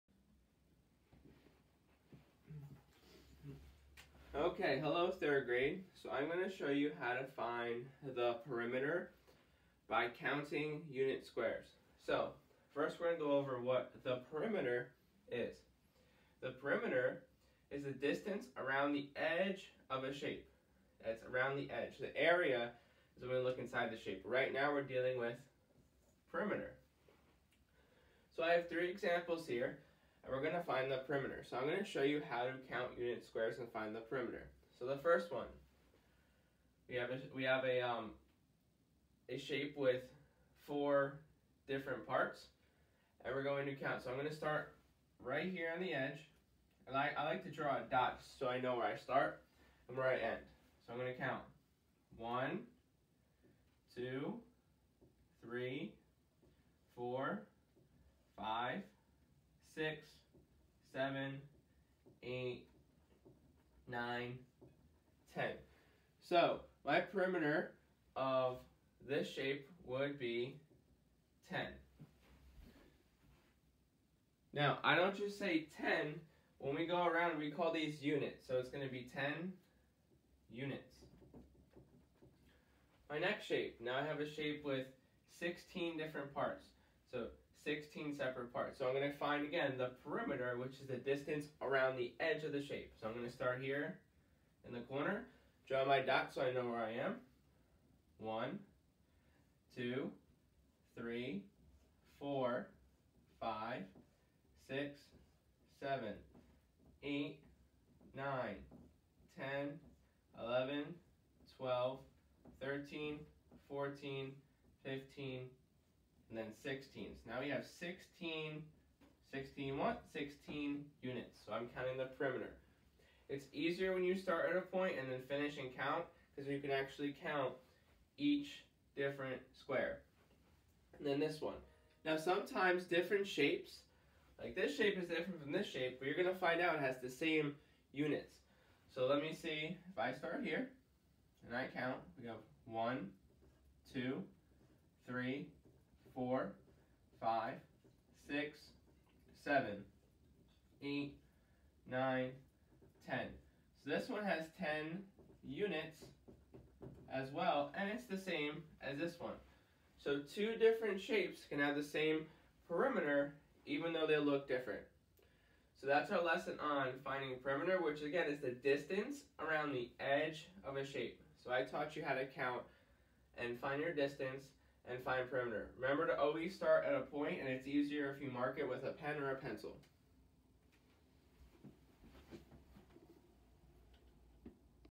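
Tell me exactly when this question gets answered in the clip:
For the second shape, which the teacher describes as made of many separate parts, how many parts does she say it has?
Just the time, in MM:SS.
01:25.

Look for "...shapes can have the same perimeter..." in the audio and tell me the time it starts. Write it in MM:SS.
02:41.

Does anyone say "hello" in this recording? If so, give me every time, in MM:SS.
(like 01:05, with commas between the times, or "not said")
00:04.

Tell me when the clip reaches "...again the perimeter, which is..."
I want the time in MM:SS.
01:29.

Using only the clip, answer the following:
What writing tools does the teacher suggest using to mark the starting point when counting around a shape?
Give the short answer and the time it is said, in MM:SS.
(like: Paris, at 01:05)
a pen or a pencil, at 02:58.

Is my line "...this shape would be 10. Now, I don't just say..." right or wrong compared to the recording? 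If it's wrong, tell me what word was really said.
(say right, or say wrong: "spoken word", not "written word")
right.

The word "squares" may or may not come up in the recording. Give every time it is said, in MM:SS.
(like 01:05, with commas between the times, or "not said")
00:11, 00:33, 02:09.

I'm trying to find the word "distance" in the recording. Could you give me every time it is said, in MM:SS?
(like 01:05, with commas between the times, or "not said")
00:17, 01:30, 02:48, 02:53.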